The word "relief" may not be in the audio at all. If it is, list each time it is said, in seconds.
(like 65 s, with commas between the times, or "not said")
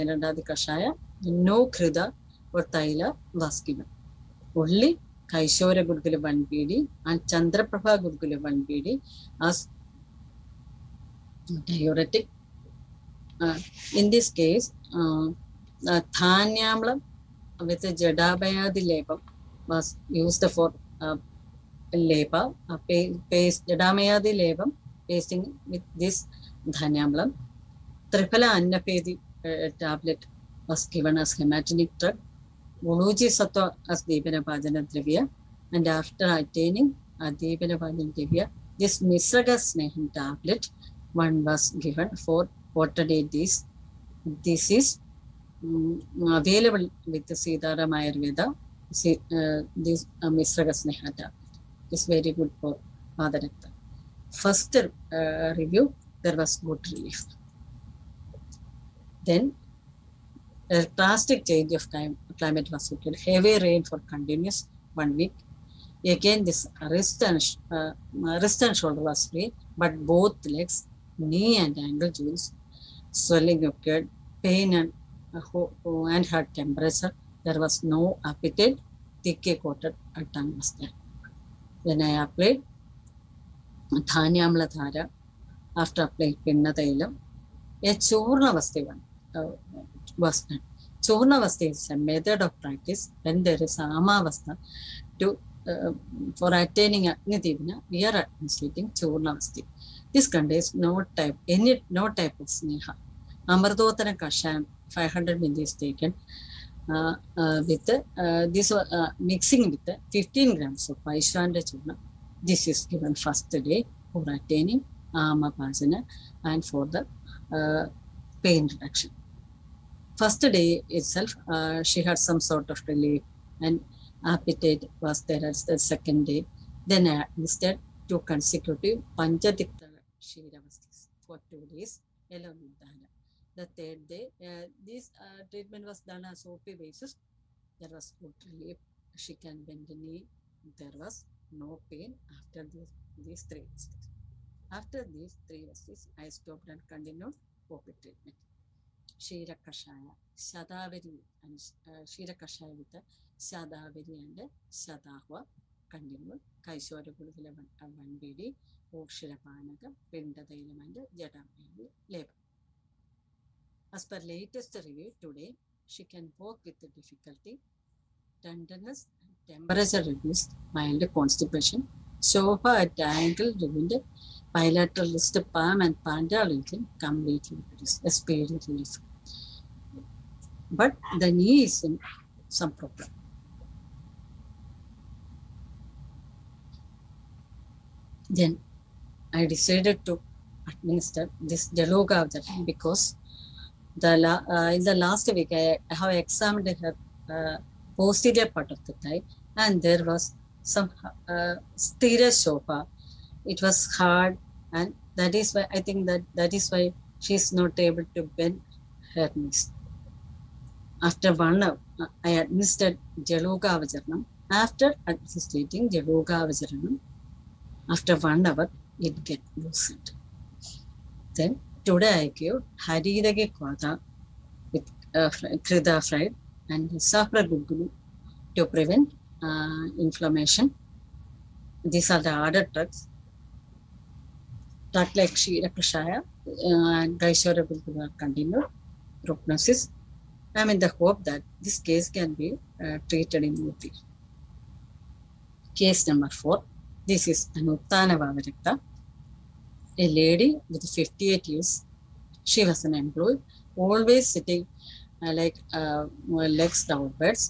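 56 s, 122 s, 138 s, 178 s.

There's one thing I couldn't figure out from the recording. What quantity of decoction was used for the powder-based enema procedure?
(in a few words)
500 ml.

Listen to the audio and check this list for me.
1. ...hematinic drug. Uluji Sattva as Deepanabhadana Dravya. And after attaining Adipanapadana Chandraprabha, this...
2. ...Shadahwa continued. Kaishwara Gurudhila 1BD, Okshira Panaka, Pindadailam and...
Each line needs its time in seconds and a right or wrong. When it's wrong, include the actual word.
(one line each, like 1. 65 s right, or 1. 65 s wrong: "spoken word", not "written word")
1. 31 s wrong: "Divya", not "Chandraprabha"
2. 154 s right.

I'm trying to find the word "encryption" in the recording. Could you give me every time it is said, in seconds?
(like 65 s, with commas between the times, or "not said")
not said.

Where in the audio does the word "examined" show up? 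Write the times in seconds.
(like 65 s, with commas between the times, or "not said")
196 s.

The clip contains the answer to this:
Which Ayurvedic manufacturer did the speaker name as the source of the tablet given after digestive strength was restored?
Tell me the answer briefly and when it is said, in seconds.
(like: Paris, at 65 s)
Sitaram Ayurveda, at 47 s.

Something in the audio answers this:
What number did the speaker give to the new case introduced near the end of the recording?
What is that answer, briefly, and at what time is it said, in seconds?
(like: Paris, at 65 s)
4, at 246 s.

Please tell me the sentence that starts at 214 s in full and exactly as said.
After administering Jaluga Vajaranam, after one hour, it get loosened.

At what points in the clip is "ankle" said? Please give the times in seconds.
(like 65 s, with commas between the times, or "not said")
71 s, 173 s.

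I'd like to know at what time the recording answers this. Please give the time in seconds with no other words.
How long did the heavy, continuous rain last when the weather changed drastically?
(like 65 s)
64 s.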